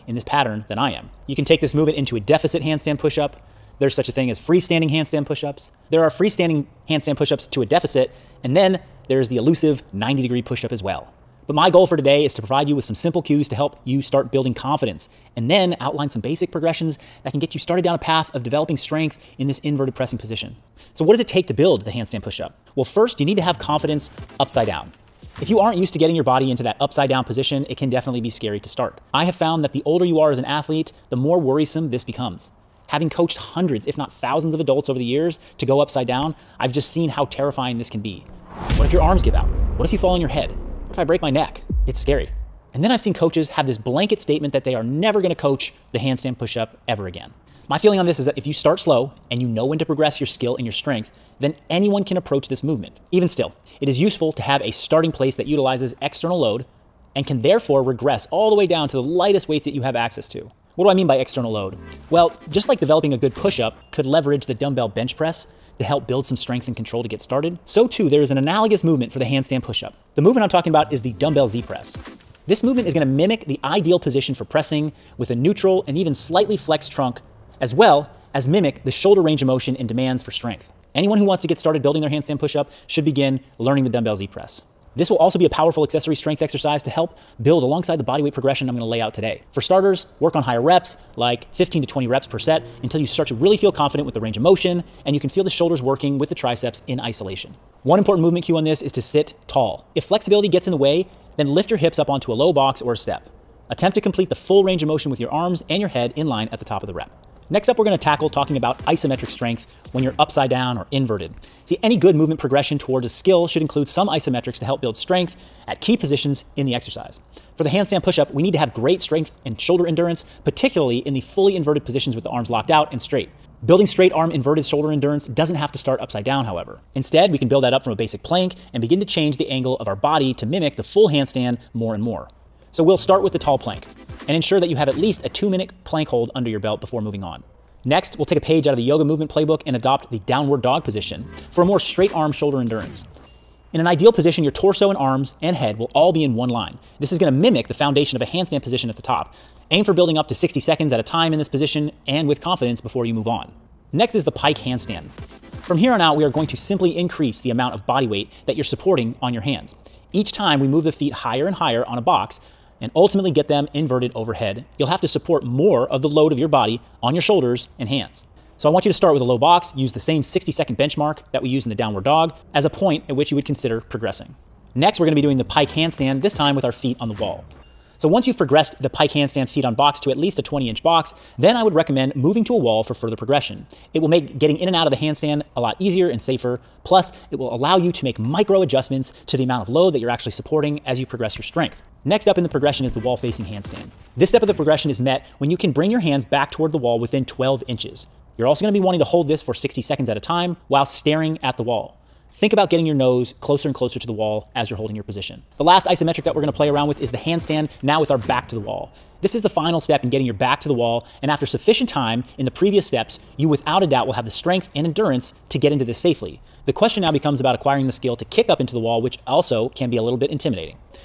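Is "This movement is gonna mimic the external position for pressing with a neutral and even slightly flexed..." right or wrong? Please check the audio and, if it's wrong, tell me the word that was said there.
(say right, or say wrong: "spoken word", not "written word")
wrong: "ideal", not "external".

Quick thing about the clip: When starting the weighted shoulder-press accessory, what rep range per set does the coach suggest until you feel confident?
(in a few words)
15 to 20.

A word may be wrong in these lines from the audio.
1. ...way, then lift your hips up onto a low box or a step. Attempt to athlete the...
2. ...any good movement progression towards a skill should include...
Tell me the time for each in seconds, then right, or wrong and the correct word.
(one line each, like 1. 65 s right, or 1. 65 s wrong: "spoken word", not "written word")
1. 100 s wrong: "complete", not "athlete"
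2. 111 s right.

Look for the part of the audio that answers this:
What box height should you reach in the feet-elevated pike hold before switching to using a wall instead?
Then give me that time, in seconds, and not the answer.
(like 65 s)
180 s.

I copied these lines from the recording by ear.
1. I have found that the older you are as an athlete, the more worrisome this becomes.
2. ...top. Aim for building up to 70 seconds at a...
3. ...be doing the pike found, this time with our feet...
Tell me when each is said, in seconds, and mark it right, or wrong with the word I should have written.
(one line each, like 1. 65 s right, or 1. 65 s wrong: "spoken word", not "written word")
1. 29 s right
2. 149 s wrong: "60", not "70"
3. 175 s wrong: "handstand", not "found".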